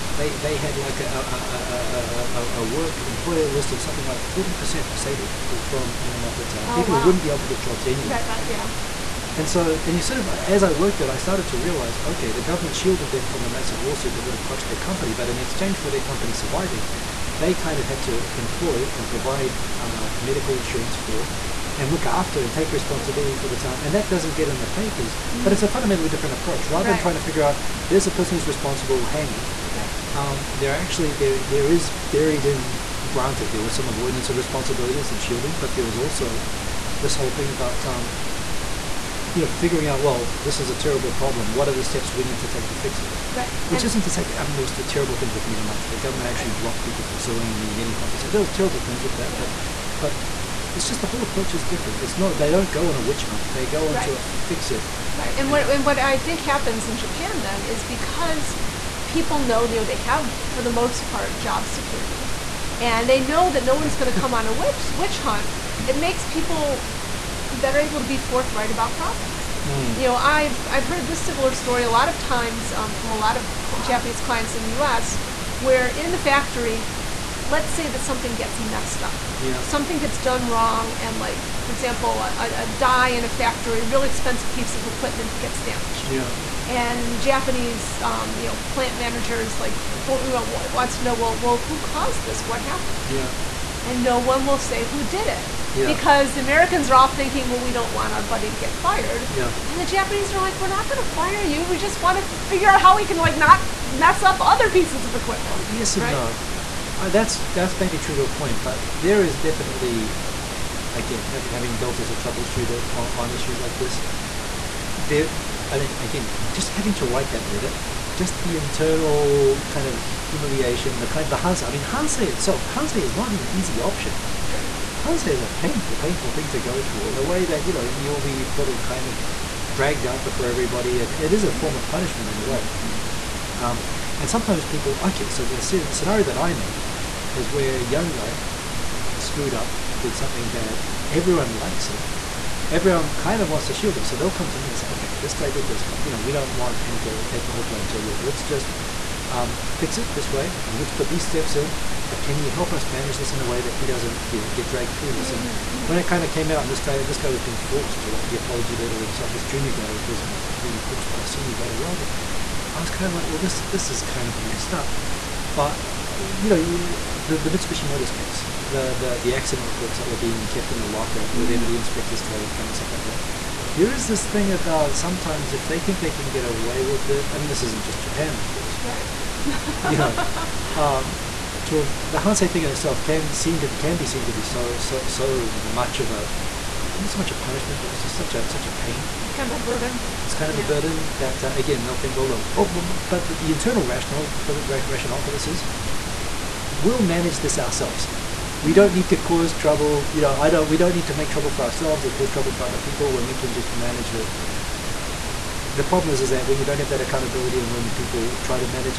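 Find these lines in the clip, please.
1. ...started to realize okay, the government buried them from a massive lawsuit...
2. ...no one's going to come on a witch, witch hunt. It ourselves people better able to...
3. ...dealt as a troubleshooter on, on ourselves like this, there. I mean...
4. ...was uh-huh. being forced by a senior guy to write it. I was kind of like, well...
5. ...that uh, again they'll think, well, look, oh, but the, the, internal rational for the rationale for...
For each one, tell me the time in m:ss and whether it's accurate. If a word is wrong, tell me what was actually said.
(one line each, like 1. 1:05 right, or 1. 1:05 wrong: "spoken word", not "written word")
1. 0:11 wrong: "shielded", not "buried"
2. 1:03 wrong: "makes", not "ourselves"
3. 1:51 wrong: "issues", not "ourselves"
4. 2:40 right
5. 3:11 right.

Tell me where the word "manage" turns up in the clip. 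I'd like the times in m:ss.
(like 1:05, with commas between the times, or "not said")
2:32, 3:17, 3:23.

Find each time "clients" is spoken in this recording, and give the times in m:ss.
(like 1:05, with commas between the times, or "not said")
1:14.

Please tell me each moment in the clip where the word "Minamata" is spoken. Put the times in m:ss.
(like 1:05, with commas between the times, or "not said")
0:05, 0:45.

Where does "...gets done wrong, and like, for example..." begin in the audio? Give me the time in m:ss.
1:19.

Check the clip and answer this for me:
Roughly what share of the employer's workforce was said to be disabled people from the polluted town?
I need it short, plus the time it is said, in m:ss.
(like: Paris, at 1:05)
40%, at 0:04.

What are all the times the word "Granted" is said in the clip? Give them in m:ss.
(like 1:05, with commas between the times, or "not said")
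0:33.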